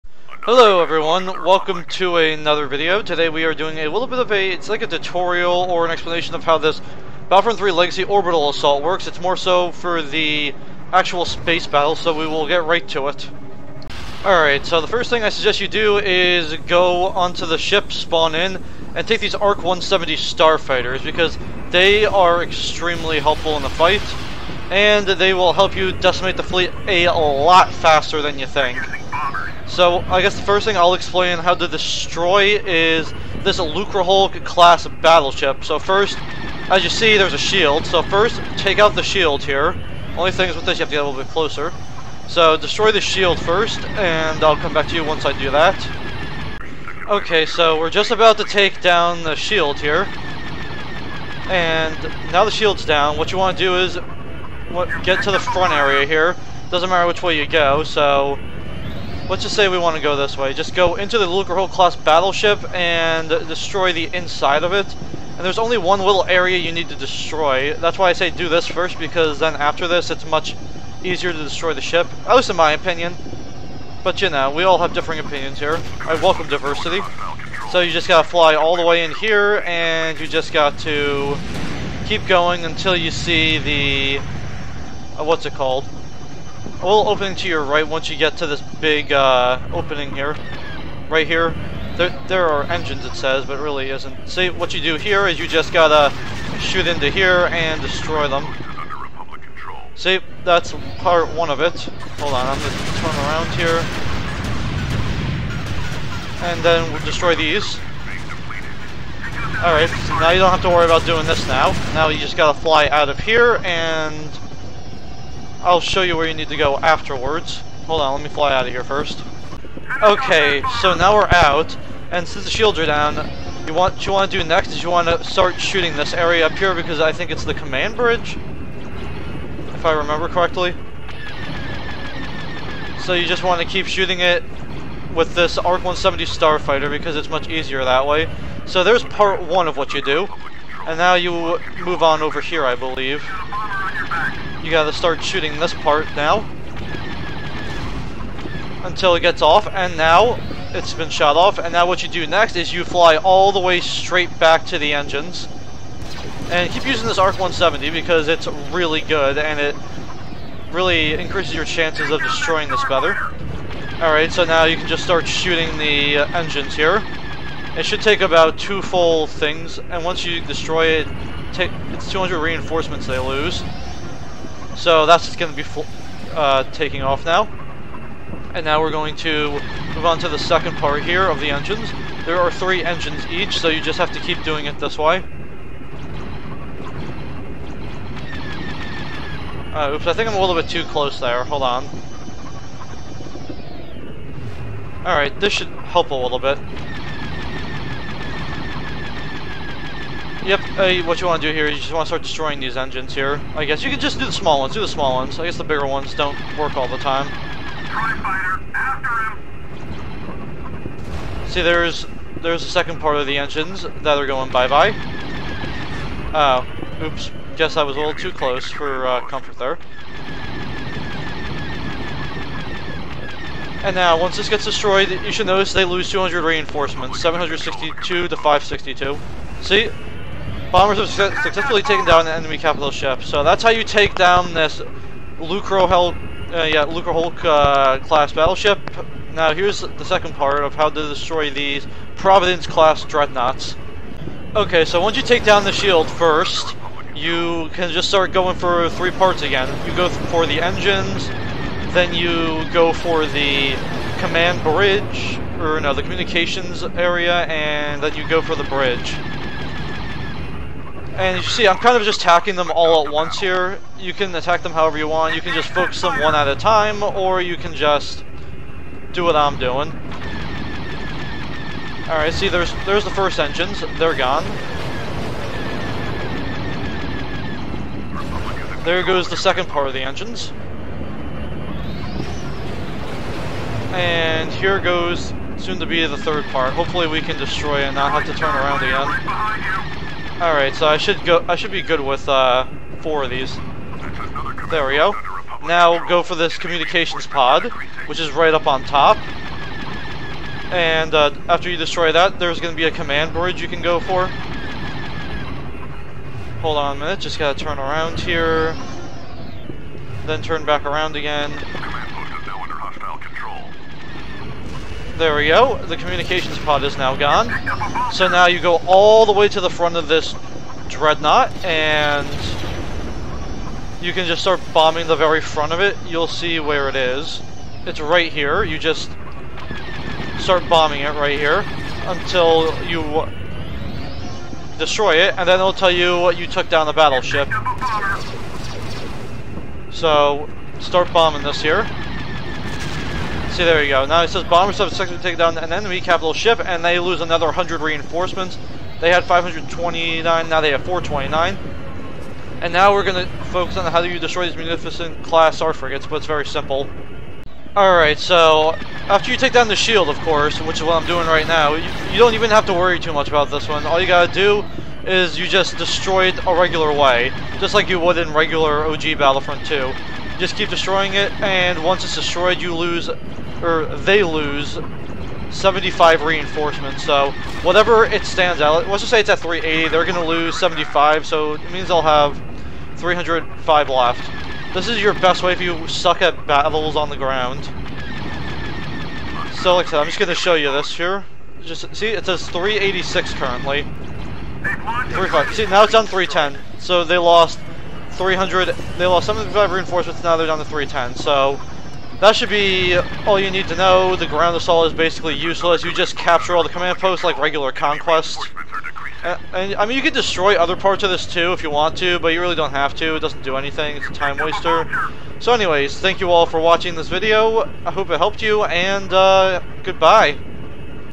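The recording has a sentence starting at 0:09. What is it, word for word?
It's more so for the actual space battle, so we will get right to it.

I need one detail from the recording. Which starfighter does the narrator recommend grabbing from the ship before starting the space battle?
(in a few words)
ARC 170.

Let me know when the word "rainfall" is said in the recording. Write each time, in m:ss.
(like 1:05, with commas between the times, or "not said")
not said.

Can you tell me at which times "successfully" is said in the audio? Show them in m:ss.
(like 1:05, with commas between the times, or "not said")
3:51, 5:44.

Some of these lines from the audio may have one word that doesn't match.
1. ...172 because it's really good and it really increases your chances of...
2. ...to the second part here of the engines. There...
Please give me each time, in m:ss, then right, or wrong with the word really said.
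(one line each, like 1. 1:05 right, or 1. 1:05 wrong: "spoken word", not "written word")
1. 2:37 wrong: "170", not "172"
2. 3:00 right.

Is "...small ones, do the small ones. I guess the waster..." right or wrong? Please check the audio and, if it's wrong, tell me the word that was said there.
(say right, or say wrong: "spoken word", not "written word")
wrong: "bigger", not "waster".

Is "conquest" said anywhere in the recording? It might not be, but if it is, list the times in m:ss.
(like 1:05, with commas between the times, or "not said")
6:47.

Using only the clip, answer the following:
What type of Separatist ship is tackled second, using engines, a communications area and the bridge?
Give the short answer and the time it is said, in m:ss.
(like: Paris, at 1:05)
Providence class dreadnoughts, at 4:02.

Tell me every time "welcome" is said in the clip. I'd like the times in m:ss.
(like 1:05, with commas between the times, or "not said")
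0:01, 1:16.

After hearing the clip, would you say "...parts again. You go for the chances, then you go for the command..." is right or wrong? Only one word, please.
wrong.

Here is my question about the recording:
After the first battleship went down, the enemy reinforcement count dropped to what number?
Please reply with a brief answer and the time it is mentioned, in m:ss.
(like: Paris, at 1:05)
562, at 3:48.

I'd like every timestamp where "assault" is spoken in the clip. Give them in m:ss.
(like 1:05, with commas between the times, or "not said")
0:08, 6:44.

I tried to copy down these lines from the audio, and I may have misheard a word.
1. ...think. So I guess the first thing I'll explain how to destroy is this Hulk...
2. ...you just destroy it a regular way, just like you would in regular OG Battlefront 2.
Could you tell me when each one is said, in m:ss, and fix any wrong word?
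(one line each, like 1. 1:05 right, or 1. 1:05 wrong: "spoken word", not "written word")
1. 0:28 right
2. 6:05 right.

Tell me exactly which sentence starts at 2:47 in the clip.
It should take about two full things, and once you destroy it, it's 200 reinforcements they lose.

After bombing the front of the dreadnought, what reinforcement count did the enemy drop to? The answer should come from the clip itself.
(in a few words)
429.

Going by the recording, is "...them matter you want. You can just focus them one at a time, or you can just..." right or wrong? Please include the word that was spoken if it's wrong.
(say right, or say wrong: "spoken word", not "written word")
wrong: "however", not "matter".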